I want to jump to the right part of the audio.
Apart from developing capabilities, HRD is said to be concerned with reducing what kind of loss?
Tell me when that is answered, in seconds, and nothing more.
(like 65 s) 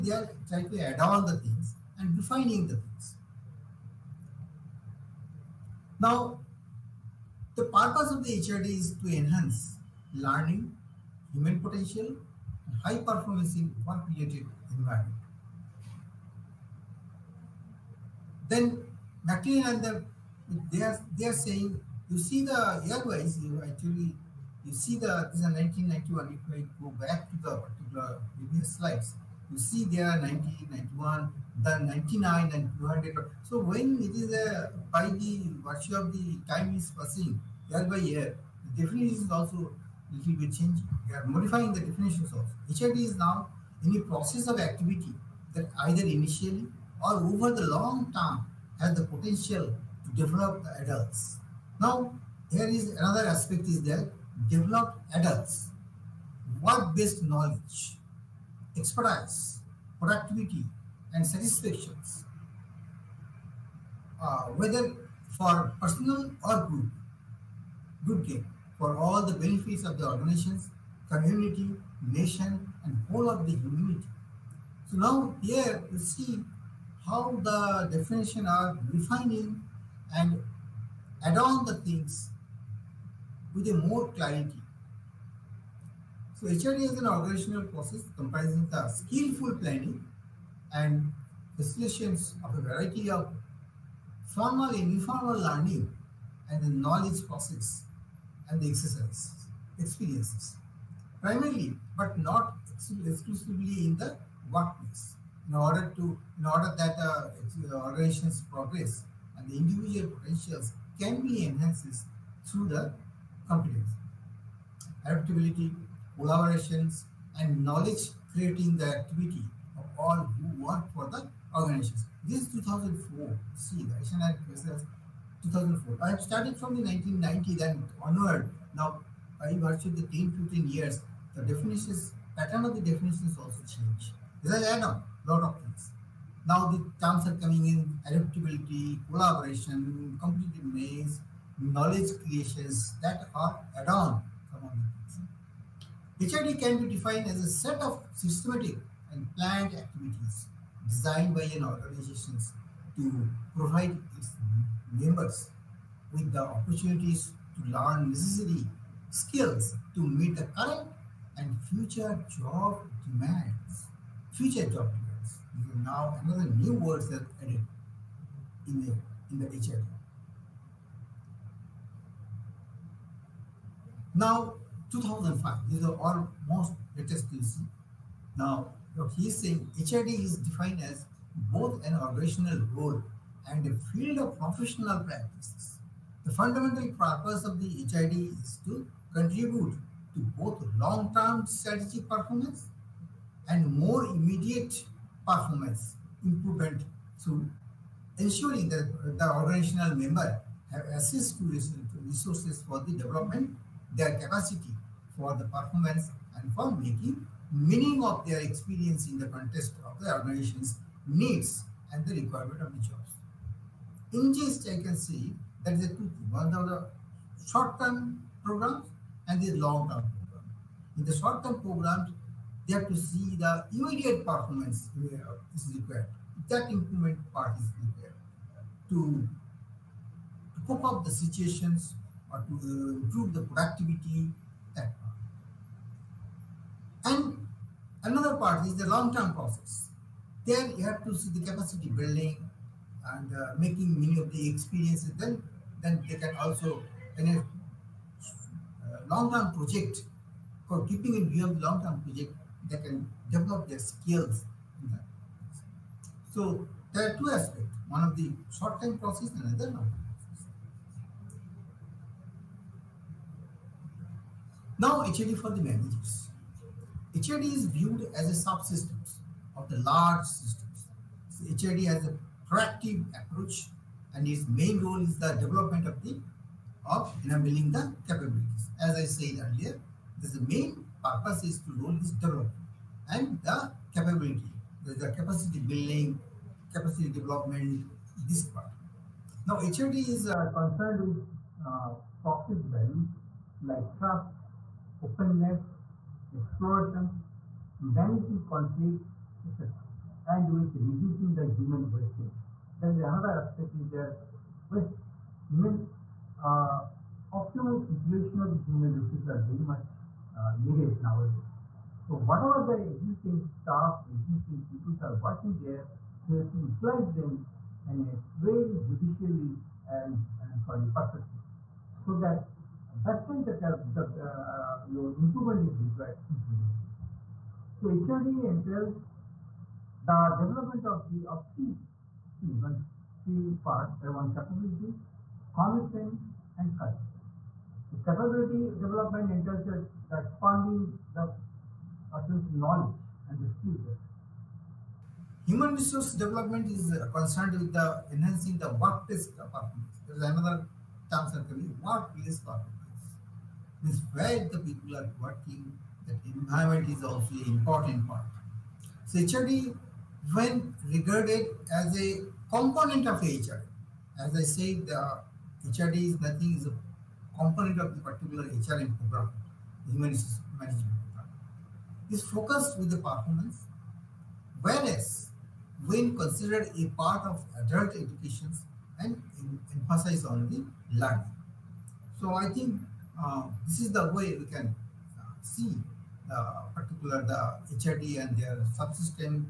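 301 s.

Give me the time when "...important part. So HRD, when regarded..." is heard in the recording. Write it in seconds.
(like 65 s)
357 s.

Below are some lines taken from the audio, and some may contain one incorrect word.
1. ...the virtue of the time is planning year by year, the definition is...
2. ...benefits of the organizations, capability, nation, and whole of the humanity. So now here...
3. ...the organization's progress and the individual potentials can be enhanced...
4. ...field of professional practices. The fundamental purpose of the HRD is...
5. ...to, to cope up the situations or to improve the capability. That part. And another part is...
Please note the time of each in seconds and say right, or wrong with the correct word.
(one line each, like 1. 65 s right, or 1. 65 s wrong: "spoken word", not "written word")
1. 35 s wrong: "passing", not "planning"
2. 69 s wrong: "community", not "capability"
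3. 107 s right
4. 183 s right
5. 228 s wrong: "productivity", not "capability".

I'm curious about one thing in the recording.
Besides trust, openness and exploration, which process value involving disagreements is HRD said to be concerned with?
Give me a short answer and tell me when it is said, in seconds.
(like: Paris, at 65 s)
managing conflict, at 297 s.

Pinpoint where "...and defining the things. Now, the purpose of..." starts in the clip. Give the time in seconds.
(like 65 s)
1 s.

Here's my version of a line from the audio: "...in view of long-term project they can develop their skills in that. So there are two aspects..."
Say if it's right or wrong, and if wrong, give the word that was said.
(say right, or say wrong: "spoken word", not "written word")
right.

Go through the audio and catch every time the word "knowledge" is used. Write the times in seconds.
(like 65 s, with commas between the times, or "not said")
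57 s, 96 s, 117 s, 141 s, 342 s.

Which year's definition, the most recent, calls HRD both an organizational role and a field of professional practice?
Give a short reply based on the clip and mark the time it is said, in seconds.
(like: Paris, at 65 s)
2005, at 174 s.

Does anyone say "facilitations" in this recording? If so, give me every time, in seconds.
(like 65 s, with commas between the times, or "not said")
91 s.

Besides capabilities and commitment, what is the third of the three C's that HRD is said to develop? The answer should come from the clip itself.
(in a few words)
cultures.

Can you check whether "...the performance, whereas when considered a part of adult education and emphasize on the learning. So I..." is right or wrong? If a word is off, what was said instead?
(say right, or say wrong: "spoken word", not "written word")
right.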